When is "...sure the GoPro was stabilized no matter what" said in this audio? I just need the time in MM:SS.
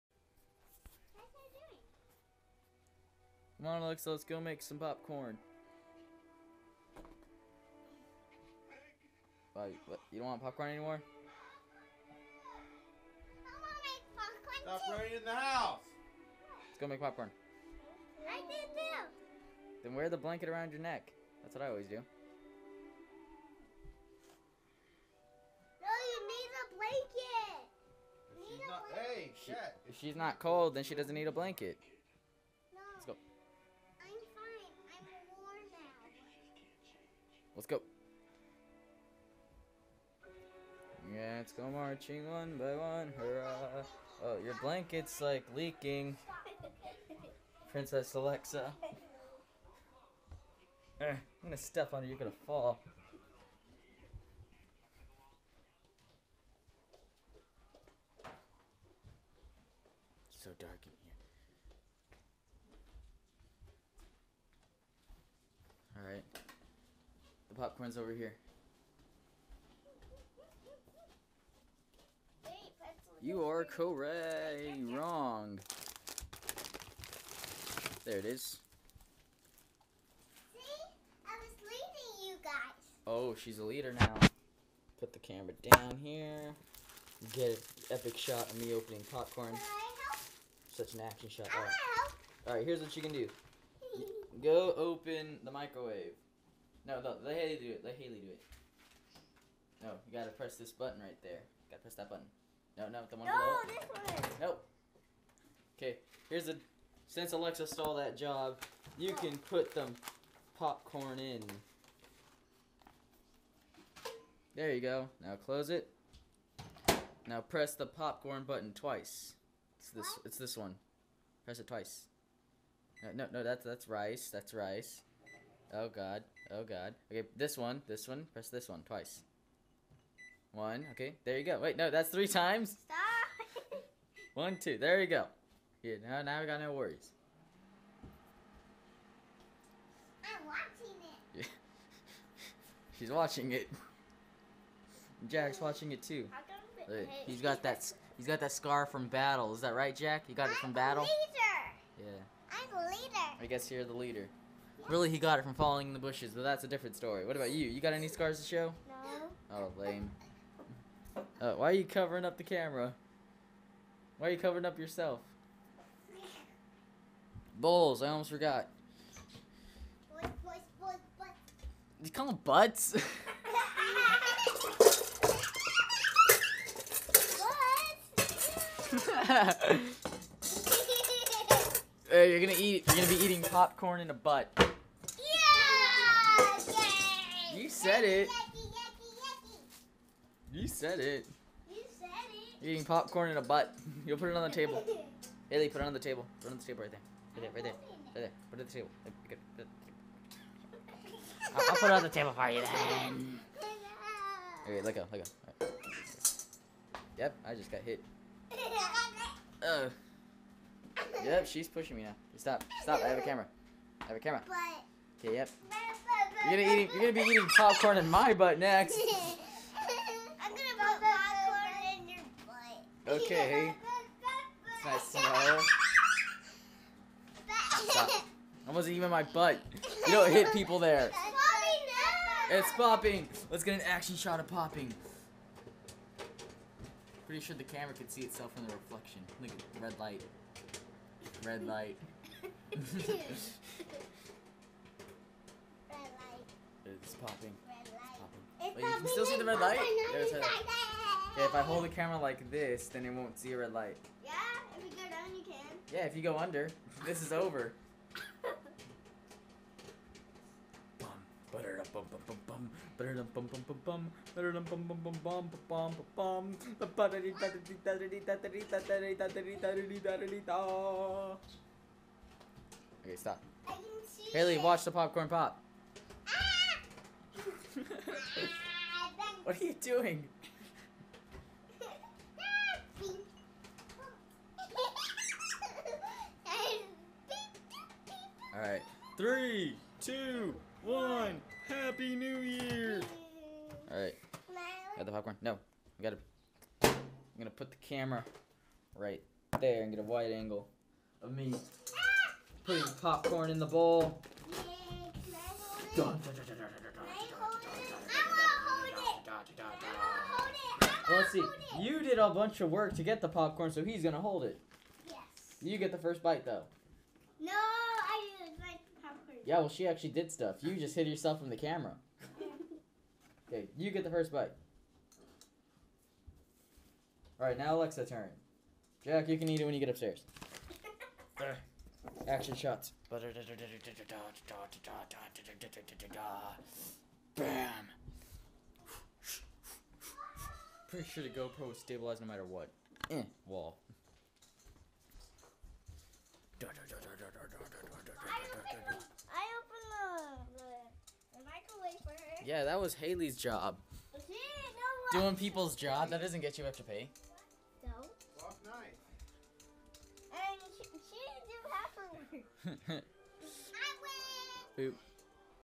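05:41.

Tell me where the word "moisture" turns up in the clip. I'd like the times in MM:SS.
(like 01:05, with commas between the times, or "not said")
not said.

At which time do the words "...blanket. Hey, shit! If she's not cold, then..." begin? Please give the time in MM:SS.
00:28.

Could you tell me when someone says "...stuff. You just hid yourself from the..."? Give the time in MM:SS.
05:20.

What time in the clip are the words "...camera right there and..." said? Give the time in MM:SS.
04:57.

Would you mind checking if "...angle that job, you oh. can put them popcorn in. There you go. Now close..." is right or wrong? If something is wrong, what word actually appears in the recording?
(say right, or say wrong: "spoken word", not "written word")
wrong: "stole", not "angle".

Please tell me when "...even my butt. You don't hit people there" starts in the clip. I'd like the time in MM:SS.
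03:48.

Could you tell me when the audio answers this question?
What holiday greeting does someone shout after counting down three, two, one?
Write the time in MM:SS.
04:51.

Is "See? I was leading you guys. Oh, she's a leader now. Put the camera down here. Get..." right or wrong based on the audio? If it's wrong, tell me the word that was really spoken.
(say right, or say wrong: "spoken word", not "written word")
right.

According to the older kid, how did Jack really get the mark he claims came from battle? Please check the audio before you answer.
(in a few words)
falling in the bushes.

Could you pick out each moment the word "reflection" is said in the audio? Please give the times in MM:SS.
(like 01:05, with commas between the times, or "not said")
03:58.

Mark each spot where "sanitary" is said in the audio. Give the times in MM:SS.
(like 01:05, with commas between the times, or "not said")
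not said.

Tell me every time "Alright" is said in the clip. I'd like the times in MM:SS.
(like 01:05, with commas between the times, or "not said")
01:06, 04:53.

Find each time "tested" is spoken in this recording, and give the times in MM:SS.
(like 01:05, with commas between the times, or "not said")
not said.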